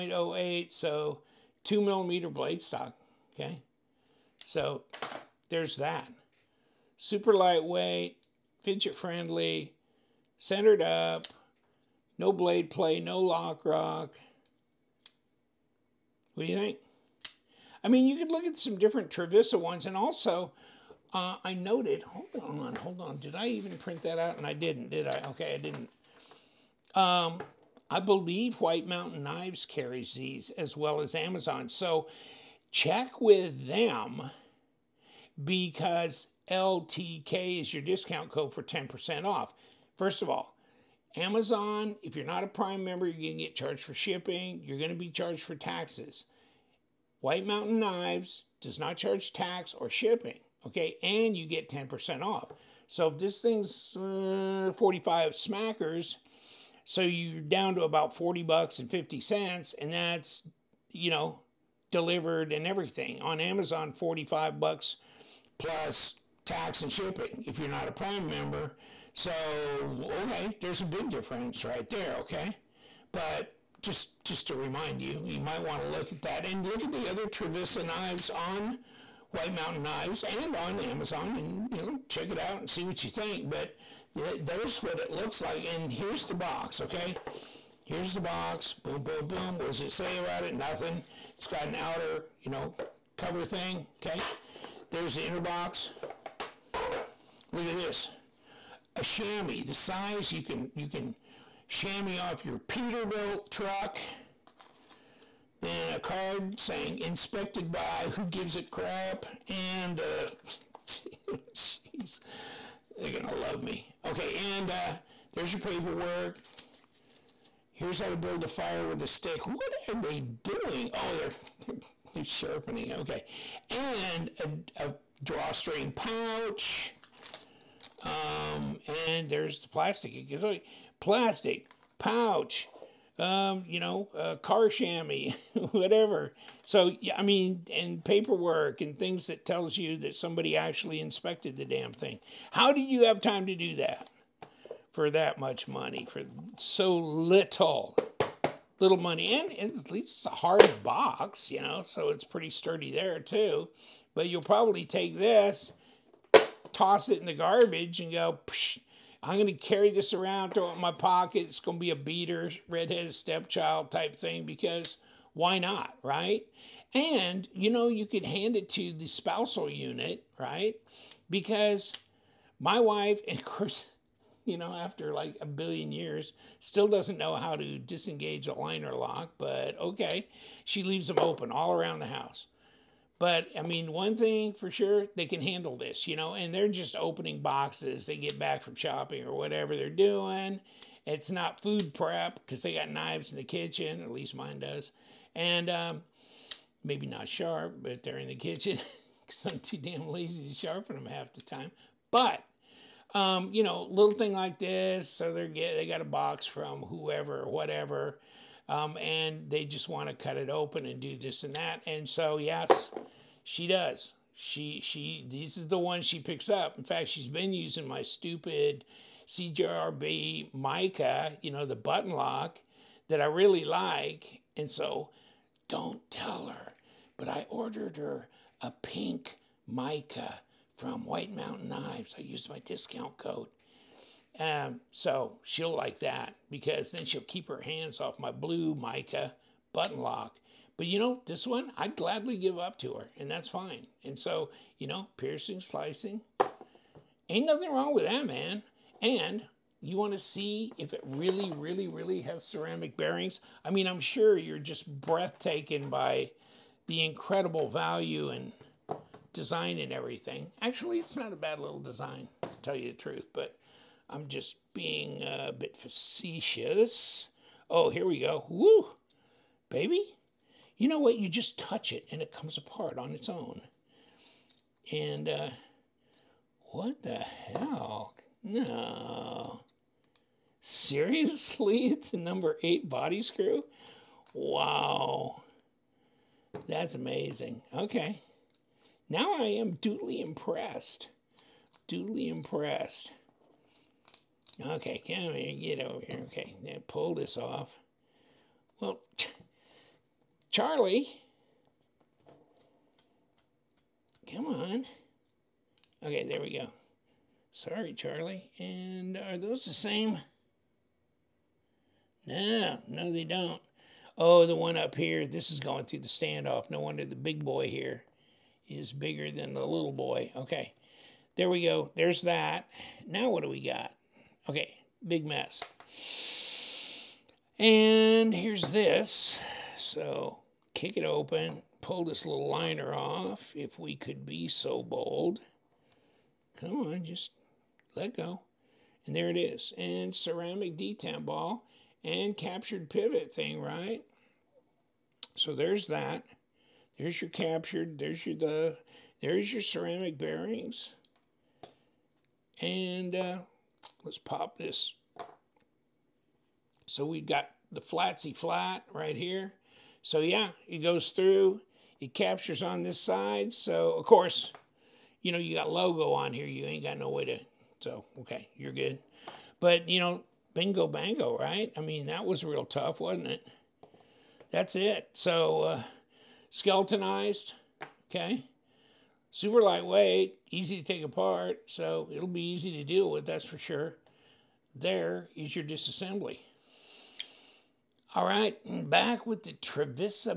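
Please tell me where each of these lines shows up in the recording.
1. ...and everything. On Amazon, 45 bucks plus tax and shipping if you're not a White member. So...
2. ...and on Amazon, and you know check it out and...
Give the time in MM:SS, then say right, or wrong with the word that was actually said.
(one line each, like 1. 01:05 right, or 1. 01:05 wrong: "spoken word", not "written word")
1. 01:02 wrong: "Prime", not "White"
2. 01:20 right.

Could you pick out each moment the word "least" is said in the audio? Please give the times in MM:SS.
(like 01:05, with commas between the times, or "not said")
02:29, 03:14.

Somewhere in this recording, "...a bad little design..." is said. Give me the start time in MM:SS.
04:21.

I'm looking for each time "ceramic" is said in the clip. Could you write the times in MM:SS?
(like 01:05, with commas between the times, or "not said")
04:12, 05:40, 05:49.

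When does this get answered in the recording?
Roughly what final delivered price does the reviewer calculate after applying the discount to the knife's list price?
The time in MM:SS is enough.
00:58.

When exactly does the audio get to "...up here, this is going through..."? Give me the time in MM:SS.
05:14.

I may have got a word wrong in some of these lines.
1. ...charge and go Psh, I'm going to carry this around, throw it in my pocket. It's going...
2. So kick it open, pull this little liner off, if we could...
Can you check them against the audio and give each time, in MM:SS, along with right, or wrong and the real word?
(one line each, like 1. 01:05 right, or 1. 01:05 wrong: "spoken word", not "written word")
1. 02:37 wrong: "garbage", not "charge"
2. 05:29 right.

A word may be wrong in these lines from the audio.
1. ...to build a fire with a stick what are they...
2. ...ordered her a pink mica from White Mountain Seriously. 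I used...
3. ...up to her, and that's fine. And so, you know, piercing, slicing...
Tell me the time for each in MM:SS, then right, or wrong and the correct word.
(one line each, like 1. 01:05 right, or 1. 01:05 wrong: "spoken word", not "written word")
1. 01:58 right
2. 03:47 wrong: "Knives", not "Seriously"
3. 04:02 right.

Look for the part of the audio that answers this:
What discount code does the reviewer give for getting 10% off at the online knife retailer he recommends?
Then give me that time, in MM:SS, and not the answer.
00:36.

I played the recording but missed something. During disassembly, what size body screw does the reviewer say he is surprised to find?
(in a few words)
number 8.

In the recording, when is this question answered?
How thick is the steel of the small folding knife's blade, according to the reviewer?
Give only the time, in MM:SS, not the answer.
00:01.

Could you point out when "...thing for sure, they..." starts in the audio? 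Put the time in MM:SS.
03:04.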